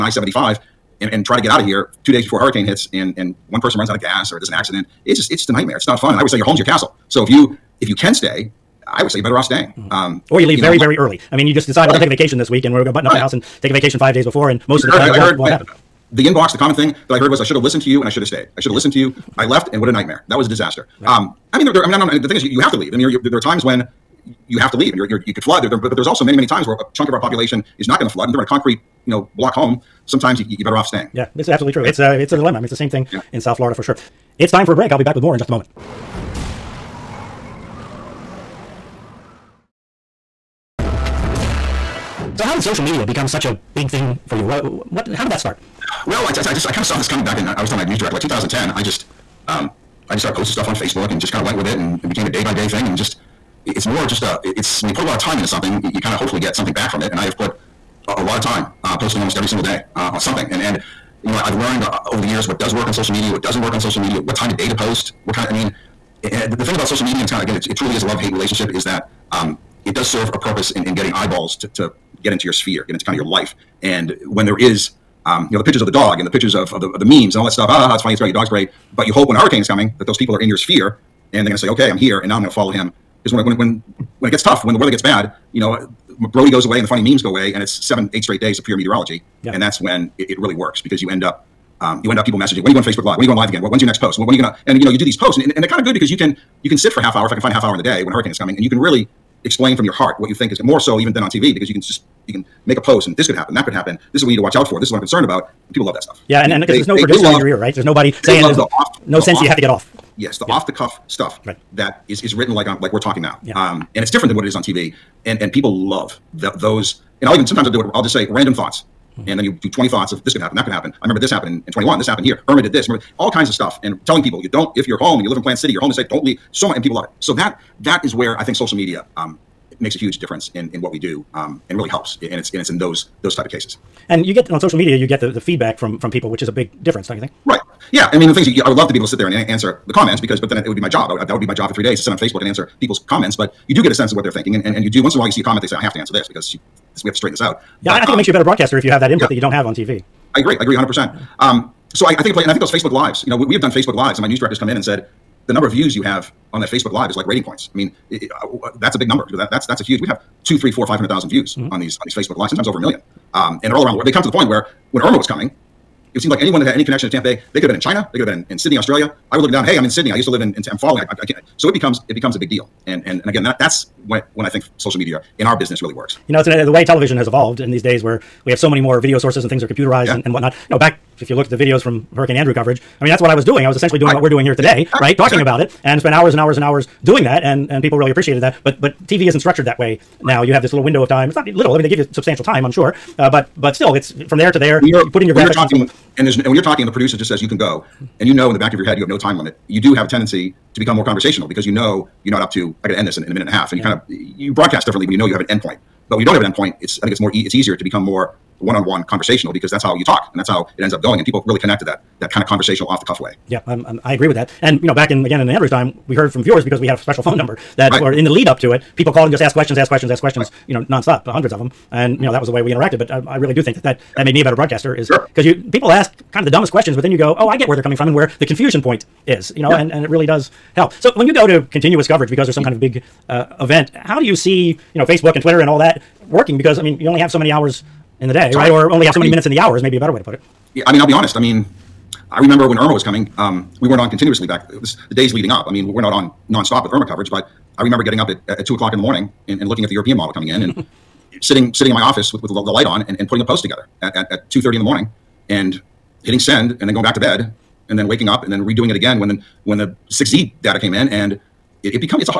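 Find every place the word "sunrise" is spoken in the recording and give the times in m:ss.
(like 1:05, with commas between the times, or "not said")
not said.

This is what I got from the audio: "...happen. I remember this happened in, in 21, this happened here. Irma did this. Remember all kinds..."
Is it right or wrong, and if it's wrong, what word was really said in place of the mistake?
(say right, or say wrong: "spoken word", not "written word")
right.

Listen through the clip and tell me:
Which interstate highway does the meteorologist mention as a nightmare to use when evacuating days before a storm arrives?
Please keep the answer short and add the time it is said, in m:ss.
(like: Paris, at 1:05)
I-75, at 0:00.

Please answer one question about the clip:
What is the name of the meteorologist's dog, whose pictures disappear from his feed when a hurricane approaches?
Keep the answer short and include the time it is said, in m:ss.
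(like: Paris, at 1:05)
Brody, at 1:26.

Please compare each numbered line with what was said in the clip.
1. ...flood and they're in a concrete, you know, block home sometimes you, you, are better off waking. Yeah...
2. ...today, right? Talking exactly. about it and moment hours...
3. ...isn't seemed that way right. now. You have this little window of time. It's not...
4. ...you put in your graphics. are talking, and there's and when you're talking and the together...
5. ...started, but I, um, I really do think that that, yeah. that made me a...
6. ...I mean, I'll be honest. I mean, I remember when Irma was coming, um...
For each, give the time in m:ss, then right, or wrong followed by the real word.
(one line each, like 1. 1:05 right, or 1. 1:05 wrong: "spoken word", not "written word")
1. 0:28 wrong: "staying", not "waking"
2. 3:04 wrong: "spent", not "moment"
3. 3:09 wrong: "structured", not "seemed"
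4. 3:15 wrong: "producer", not "together"
5. 3:42 wrong: "interacted", not "started"
6. 4:00 right.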